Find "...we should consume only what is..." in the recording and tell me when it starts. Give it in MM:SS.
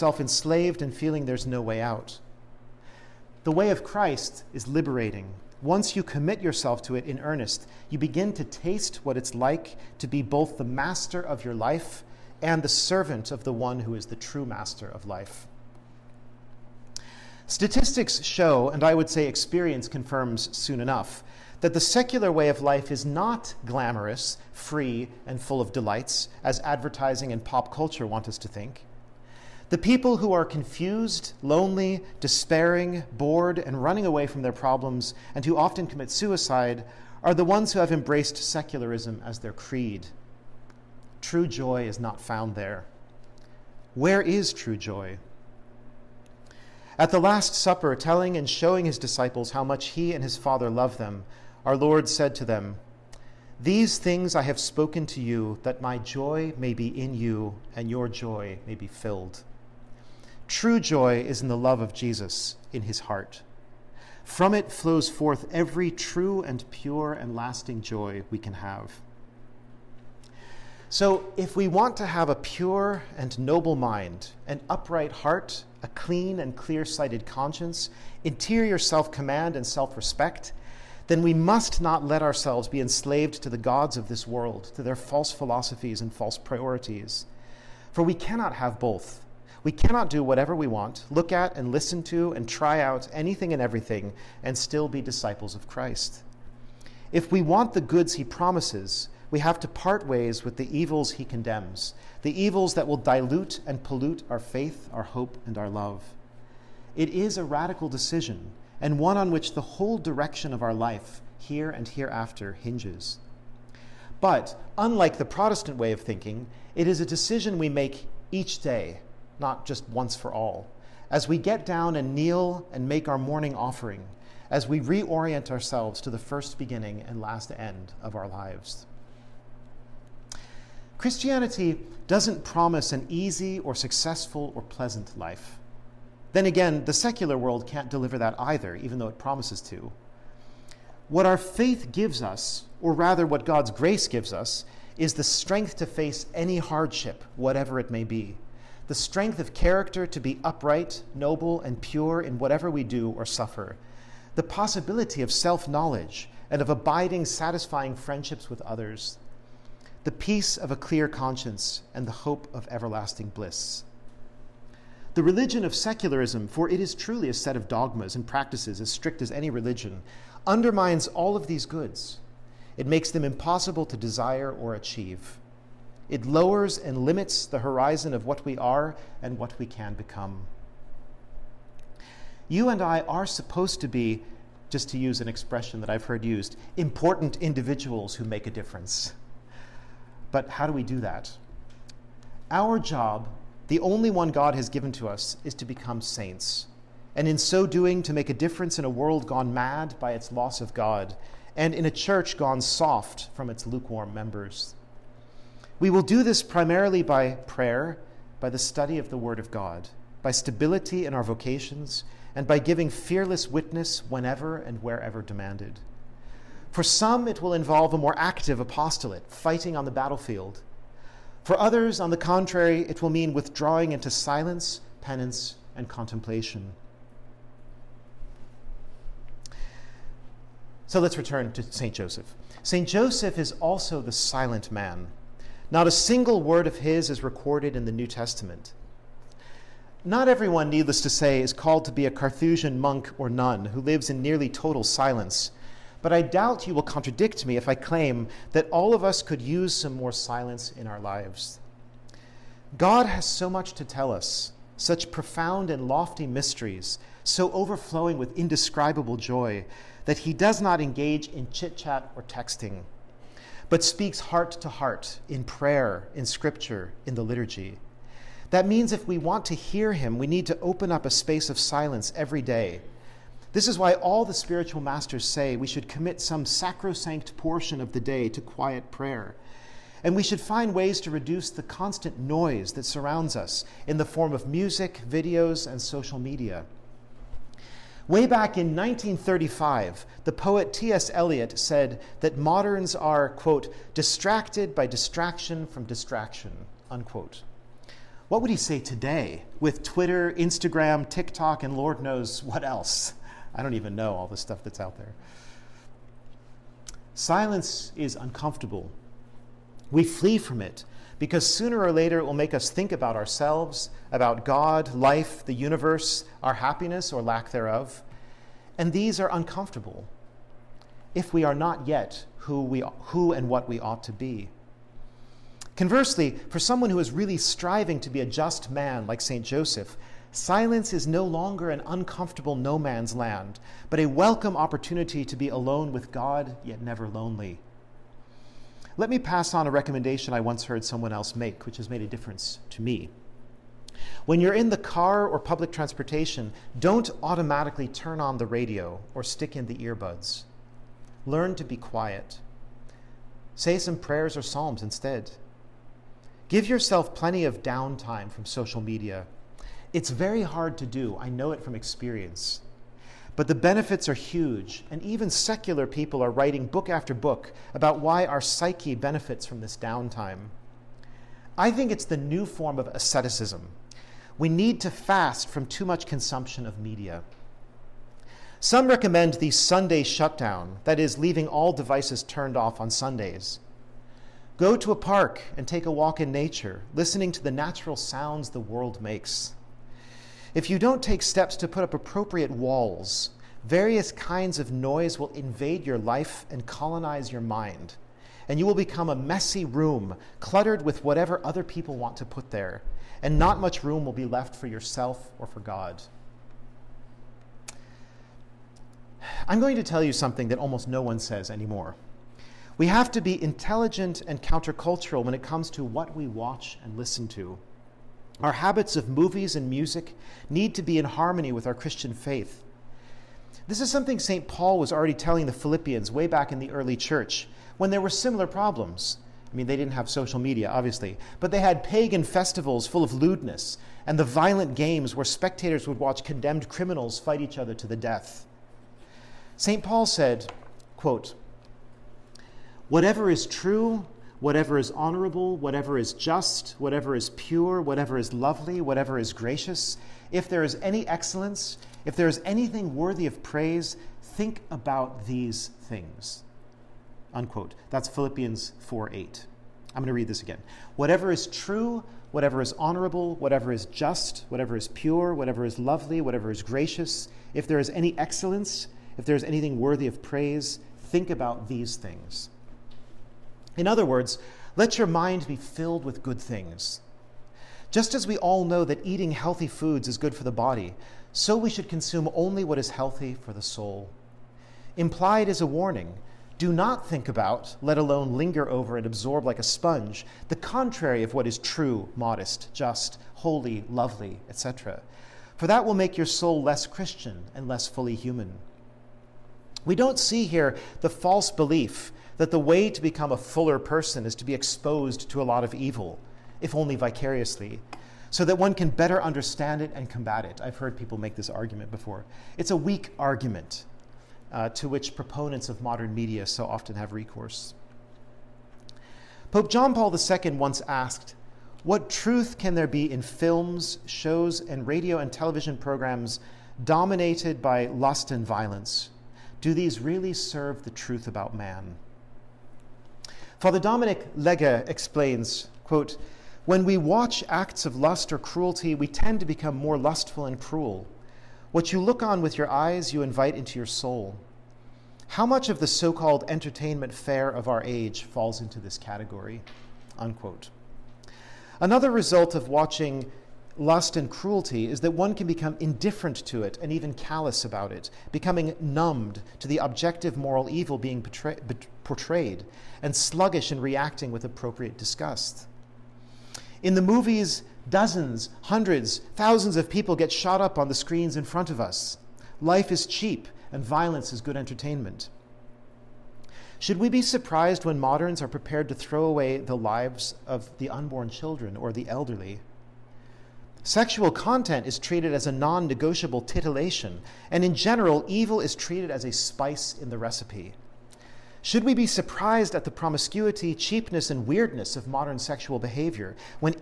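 08:01.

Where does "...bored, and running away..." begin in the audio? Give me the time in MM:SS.
00:33.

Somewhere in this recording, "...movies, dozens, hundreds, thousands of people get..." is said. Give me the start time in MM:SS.
09:27.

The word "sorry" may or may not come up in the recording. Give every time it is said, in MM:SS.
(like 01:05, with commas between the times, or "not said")
not said.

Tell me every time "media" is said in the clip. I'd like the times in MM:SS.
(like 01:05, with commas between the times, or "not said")
04:46, 05:58, 06:16, 07:10, 08:36.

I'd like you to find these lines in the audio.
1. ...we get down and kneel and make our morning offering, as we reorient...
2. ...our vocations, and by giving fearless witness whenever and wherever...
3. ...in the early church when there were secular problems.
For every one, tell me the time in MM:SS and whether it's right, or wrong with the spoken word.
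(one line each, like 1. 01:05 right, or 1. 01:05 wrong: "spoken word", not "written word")
1. 02:01 right
2. 03:31 right
3. 07:06 wrong: "similar", not "secular".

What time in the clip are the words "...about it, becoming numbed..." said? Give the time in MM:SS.
09:17.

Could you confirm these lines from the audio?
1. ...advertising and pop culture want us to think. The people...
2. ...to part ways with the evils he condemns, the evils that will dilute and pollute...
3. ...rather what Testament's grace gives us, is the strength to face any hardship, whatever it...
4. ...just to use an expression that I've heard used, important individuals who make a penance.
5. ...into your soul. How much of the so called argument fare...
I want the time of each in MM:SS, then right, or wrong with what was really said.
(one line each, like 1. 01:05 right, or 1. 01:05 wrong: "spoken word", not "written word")
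1. 00:26 right
2. 01:39 right
3. 02:22 wrong: "God", not "Testament"
4. 03:04 wrong: "difference", not "penance"
5. 09:03 wrong: "entertainment", not "argument".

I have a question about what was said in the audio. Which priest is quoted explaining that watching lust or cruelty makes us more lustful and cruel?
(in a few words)
Father Dominic Legge.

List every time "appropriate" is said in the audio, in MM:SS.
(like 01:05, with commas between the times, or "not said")
06:31, 09:24.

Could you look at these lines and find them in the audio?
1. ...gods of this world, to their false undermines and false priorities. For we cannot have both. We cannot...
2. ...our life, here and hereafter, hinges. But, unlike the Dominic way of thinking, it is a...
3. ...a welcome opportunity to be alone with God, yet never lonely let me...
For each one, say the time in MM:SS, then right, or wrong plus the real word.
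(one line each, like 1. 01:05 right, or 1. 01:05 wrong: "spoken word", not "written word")
1. 01:23 wrong: "philosophies", not "undermines"
2. 01:50 wrong: "Protestant", not "Dominic"
3. 05:33 right.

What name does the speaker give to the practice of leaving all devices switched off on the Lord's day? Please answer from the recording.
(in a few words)
Sunday shutdown.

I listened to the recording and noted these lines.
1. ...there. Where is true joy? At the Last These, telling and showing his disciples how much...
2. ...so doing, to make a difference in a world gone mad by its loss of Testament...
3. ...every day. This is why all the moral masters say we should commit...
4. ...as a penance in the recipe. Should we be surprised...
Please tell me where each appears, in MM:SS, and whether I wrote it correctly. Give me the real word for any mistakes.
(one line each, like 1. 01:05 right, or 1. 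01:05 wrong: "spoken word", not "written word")
1. 00:42 wrong: "Supper", not "These"
2. 03:17 wrong: "God", not "Testament"
3. 04:32 wrong: "spiritual", not "moral"
4. 09:49 wrong: "spice", not "penance".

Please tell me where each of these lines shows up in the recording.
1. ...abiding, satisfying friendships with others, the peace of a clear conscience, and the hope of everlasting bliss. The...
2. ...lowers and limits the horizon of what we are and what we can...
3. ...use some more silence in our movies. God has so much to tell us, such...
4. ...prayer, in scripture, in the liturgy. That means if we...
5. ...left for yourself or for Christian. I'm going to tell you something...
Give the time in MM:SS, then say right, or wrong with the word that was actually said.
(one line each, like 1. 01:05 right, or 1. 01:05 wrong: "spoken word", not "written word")
1. 02:36 right
2. 02:56 right
3. 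04:09 wrong: "lives", not "movies"
4. 04:25 right
5. 06:44 wrong: "God", not "Christian".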